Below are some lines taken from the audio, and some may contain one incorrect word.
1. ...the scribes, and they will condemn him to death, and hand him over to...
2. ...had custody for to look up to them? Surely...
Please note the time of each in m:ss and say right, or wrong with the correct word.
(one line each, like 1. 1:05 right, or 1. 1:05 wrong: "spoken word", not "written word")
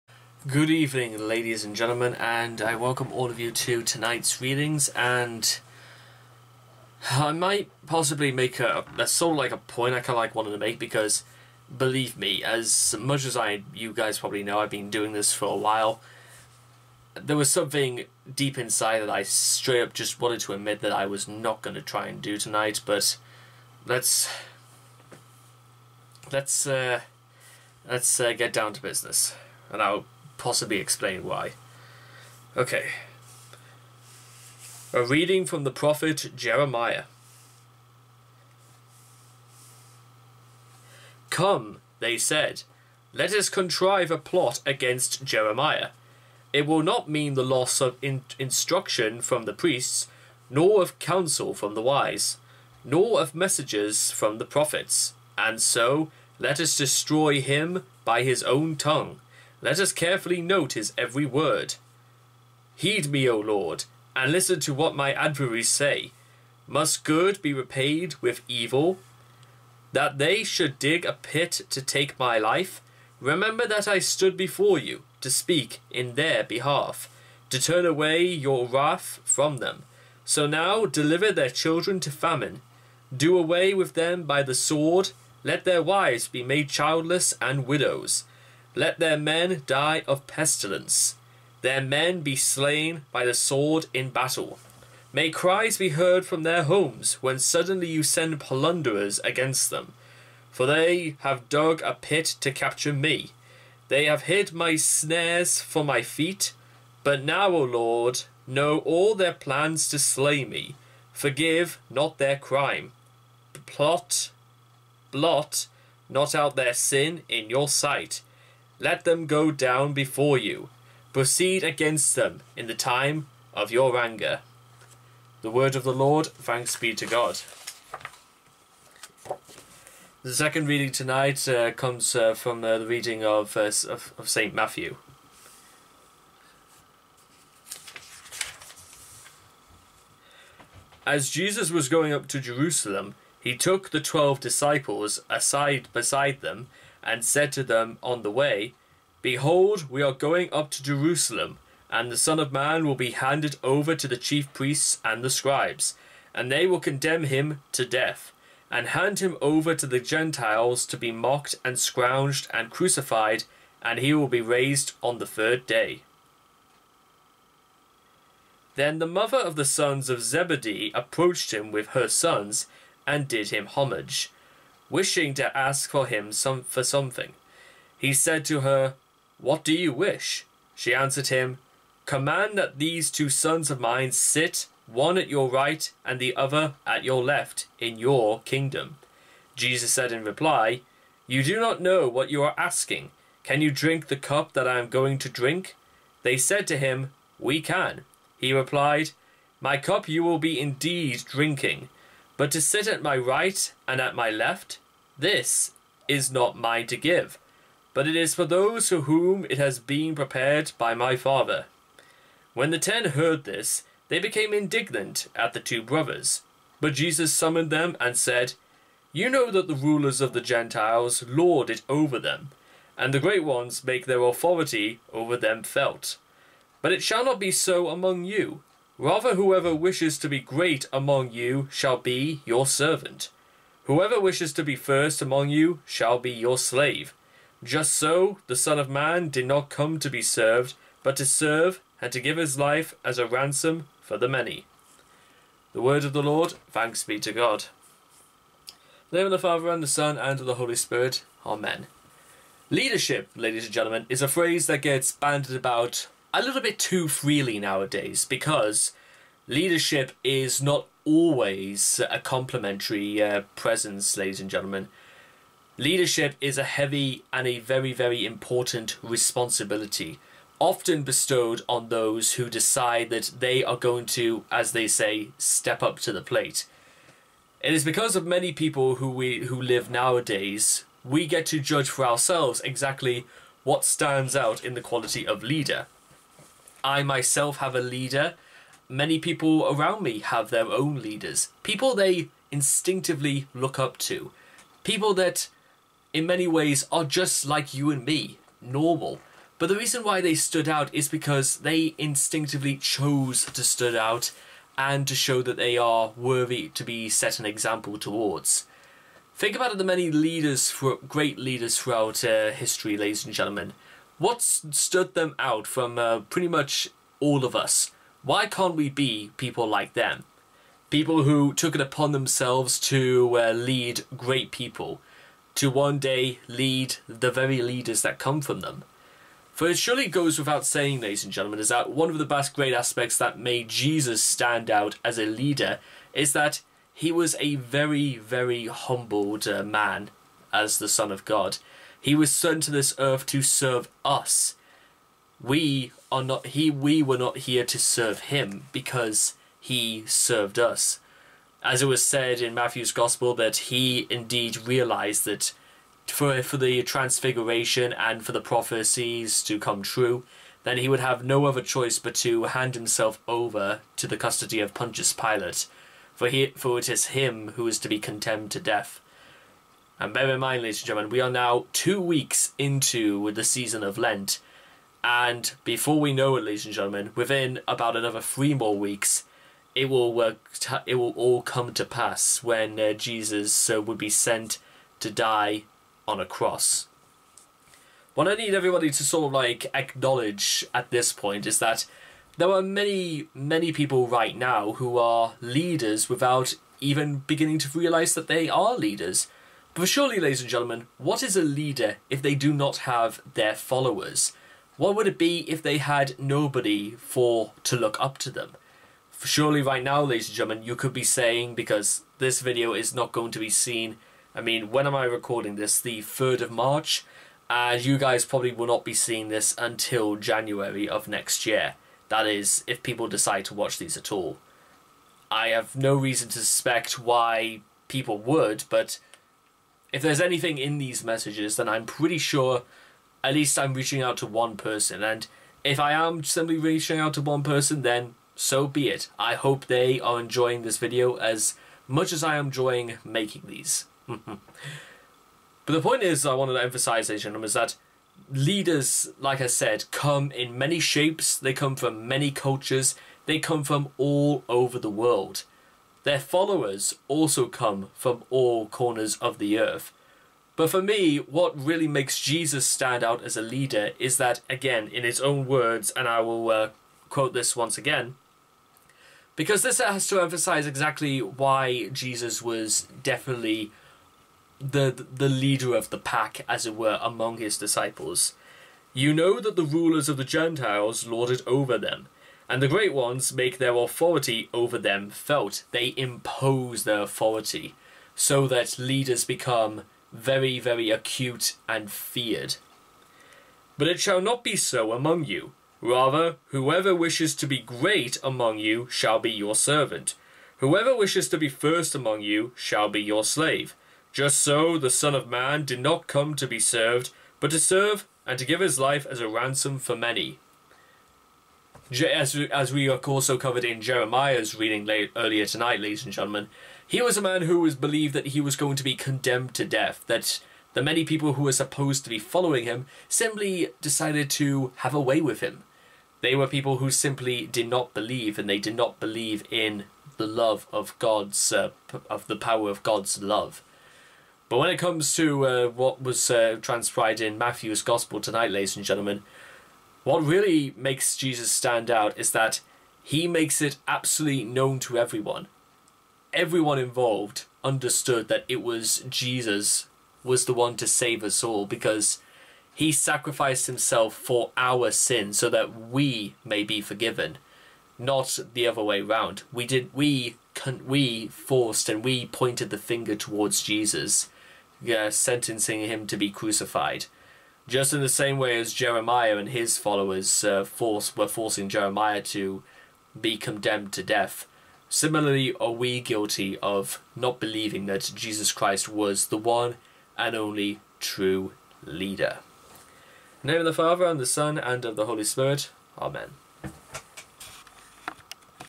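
1. 2:35 right
2. 6:45 wrong: "nobody", not "custody".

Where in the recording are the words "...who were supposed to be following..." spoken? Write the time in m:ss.
8:41.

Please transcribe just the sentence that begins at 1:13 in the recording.
Remember that I stood before you to speak in their behalf, to turn away your wrath from them.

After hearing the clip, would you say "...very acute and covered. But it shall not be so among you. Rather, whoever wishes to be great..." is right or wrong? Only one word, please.
wrong.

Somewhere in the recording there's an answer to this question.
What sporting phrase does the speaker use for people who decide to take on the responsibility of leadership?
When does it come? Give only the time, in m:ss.
4:35.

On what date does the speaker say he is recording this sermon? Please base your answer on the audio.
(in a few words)
3rd of March.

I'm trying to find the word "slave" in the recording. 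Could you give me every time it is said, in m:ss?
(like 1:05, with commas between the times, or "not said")
3:56, 8:23.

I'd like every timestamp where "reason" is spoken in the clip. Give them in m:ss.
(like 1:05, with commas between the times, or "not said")
4:59, 7:05.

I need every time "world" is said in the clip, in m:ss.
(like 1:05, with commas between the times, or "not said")
7:34.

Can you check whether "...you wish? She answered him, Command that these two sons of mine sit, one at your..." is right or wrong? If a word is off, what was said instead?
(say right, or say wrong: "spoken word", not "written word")
right.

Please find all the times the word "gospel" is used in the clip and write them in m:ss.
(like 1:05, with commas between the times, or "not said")
5:52, 8:57.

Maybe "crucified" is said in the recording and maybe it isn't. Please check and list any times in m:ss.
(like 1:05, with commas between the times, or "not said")
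2:42, 9:26.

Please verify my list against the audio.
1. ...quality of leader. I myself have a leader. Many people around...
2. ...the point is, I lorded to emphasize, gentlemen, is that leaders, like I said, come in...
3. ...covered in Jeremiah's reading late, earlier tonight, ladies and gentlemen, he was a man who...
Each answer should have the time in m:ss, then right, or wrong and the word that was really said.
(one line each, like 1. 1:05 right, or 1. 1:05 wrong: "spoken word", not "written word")
1. 4:44 right
2. 7:25 wrong: "wanted", not "lorded"
3. 8:33 right.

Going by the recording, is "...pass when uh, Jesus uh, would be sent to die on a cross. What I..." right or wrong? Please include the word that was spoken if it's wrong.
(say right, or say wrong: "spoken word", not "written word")
right.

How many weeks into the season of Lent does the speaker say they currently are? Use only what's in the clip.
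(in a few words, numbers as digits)
2.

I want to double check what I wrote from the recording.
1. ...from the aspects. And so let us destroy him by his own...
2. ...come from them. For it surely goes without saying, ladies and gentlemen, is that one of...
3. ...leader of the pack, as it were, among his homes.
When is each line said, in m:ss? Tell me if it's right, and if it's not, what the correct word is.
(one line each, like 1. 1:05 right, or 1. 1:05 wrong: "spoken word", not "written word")
1. 0:54 wrong: "prophets", not "aspects"
2. 5:28 right
3. 7:55 wrong: "disciples", not "homes".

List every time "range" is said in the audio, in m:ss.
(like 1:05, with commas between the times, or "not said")
not said.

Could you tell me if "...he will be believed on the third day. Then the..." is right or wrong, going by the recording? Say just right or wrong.
wrong.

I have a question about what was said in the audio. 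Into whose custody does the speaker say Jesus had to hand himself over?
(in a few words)
Pontius Pilate.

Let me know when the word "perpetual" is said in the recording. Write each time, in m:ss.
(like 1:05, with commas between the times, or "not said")
not said.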